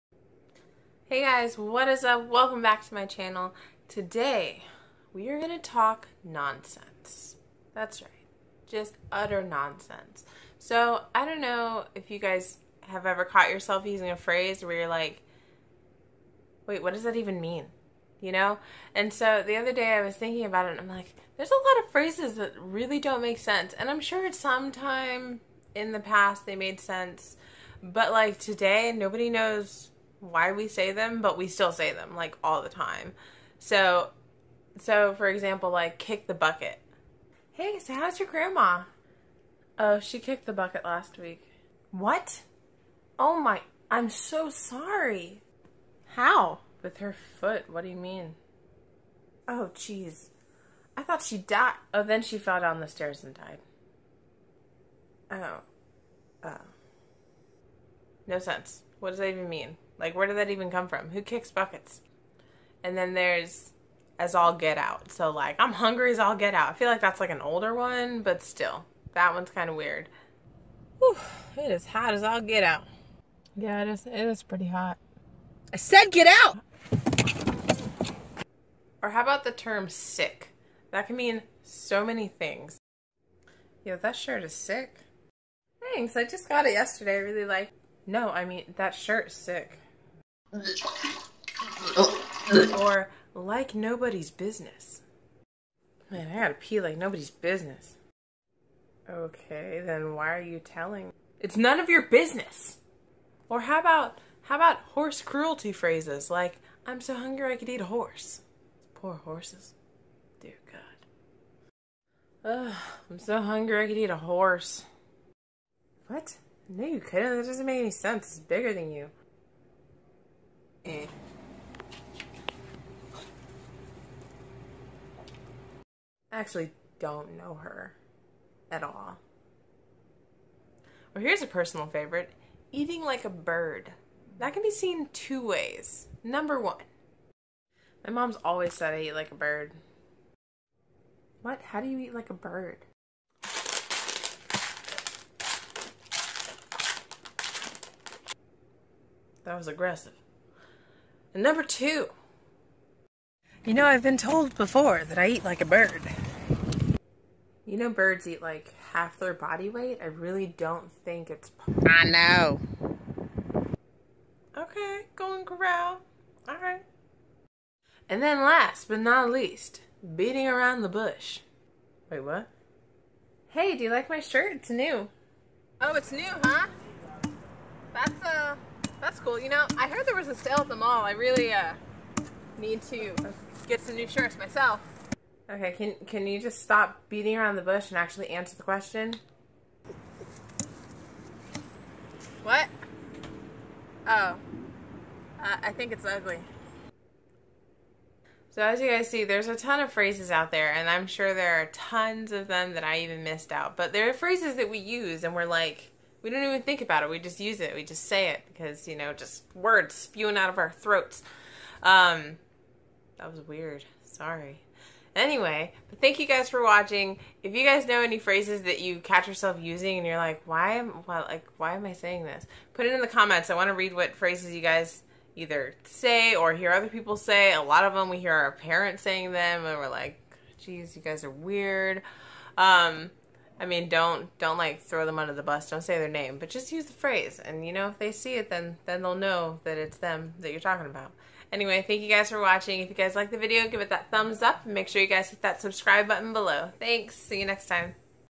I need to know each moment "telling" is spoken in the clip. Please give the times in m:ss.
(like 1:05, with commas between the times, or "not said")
1:40.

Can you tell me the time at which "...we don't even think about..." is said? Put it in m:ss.
3:26.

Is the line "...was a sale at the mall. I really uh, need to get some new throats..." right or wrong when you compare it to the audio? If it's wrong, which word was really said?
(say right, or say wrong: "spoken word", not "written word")
wrong: "shirts", not "throats".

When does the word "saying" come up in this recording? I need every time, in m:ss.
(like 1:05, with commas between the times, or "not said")
3:41, 3:49.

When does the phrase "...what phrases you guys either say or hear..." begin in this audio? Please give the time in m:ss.
3:43.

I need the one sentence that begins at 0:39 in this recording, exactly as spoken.
Oh, she kicked the bucket last week.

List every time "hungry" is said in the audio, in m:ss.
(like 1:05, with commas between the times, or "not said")
1:05, 1:47, 1:53.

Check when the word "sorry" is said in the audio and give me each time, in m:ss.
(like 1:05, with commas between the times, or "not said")
0:44, 3:34.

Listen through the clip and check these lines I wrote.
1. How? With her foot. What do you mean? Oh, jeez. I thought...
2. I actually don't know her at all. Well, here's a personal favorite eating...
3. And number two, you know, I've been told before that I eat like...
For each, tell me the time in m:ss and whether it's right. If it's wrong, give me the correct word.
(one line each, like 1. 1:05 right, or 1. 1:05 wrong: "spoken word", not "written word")
1. 0:46 right
2. 2:06 right
3. 2:31 right.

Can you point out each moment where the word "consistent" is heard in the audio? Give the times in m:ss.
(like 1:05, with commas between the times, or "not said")
not said.